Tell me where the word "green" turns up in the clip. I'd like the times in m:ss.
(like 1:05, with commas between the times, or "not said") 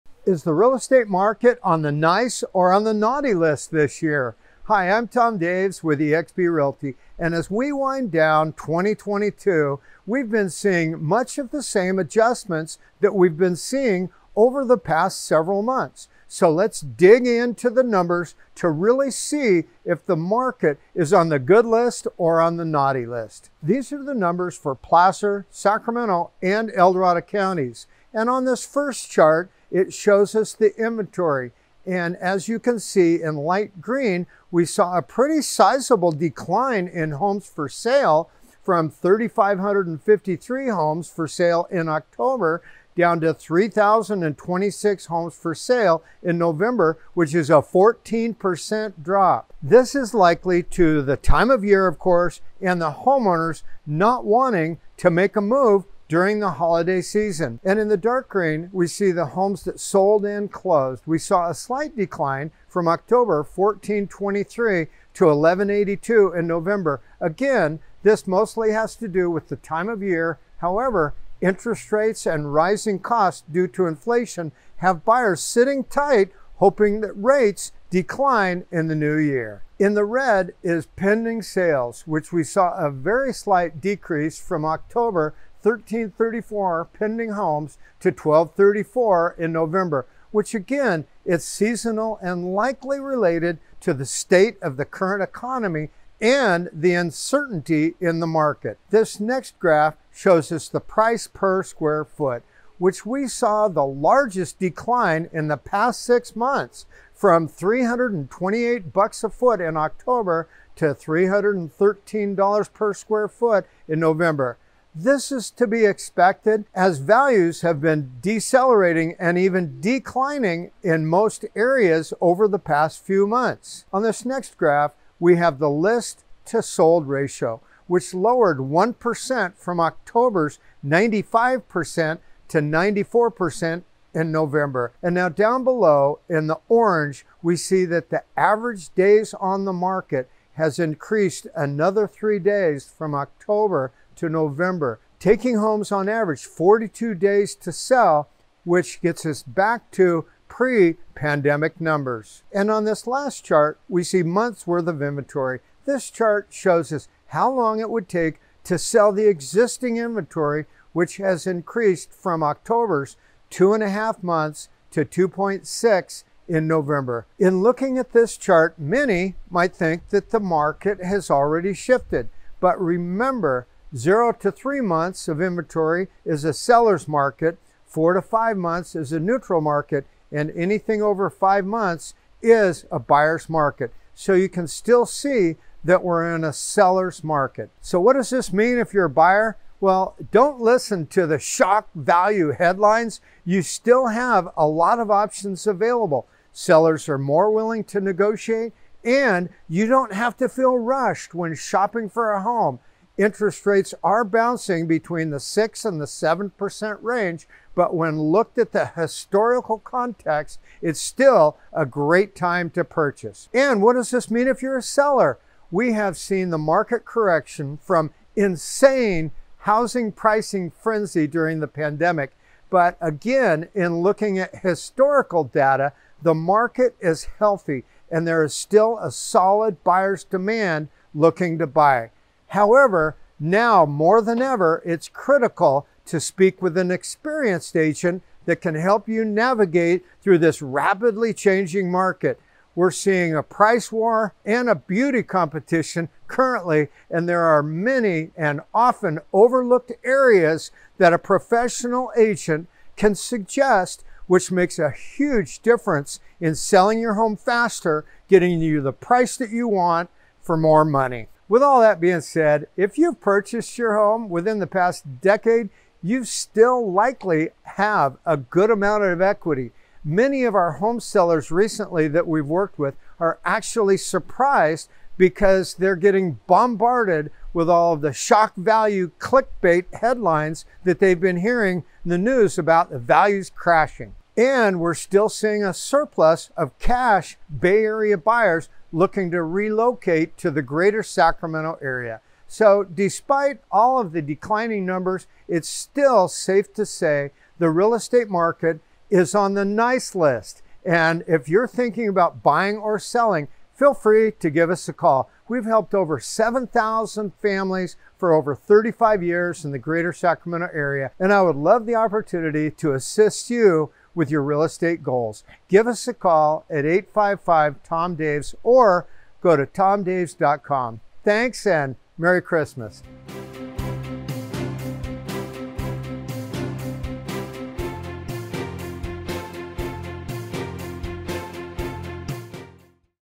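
0:33, 0:58.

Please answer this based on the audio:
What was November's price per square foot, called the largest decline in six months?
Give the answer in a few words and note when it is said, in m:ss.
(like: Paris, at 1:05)
$313, at 1:50.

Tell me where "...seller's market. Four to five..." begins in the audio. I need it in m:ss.
2:56.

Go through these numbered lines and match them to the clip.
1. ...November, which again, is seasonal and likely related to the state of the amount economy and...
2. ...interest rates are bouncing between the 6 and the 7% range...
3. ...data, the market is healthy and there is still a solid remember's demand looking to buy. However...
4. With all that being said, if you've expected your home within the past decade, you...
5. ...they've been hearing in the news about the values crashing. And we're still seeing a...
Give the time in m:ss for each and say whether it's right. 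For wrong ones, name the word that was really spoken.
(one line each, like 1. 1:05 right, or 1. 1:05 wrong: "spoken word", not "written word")
1. 1:29 wrong: "current", not "amount"
2. 3:23 right
3. 3:45 wrong: "buyer", not "remember"
4. 4:21 wrong: "purchased", not "expected"
5. 4:40 right.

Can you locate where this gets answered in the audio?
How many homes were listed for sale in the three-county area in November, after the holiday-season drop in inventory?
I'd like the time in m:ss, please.
0:43.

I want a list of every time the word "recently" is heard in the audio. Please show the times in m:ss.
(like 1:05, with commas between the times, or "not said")
4:31.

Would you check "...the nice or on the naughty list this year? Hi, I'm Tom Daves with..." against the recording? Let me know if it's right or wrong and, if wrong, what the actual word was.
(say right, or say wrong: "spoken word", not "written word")
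right.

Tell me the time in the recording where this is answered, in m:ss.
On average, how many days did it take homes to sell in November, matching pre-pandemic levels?
2:26.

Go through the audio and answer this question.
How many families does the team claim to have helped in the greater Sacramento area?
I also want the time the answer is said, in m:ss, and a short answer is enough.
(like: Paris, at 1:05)
7,000, at 5:06.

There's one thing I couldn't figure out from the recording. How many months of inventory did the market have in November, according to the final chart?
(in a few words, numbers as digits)
2.6.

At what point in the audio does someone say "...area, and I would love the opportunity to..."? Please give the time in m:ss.
5:10.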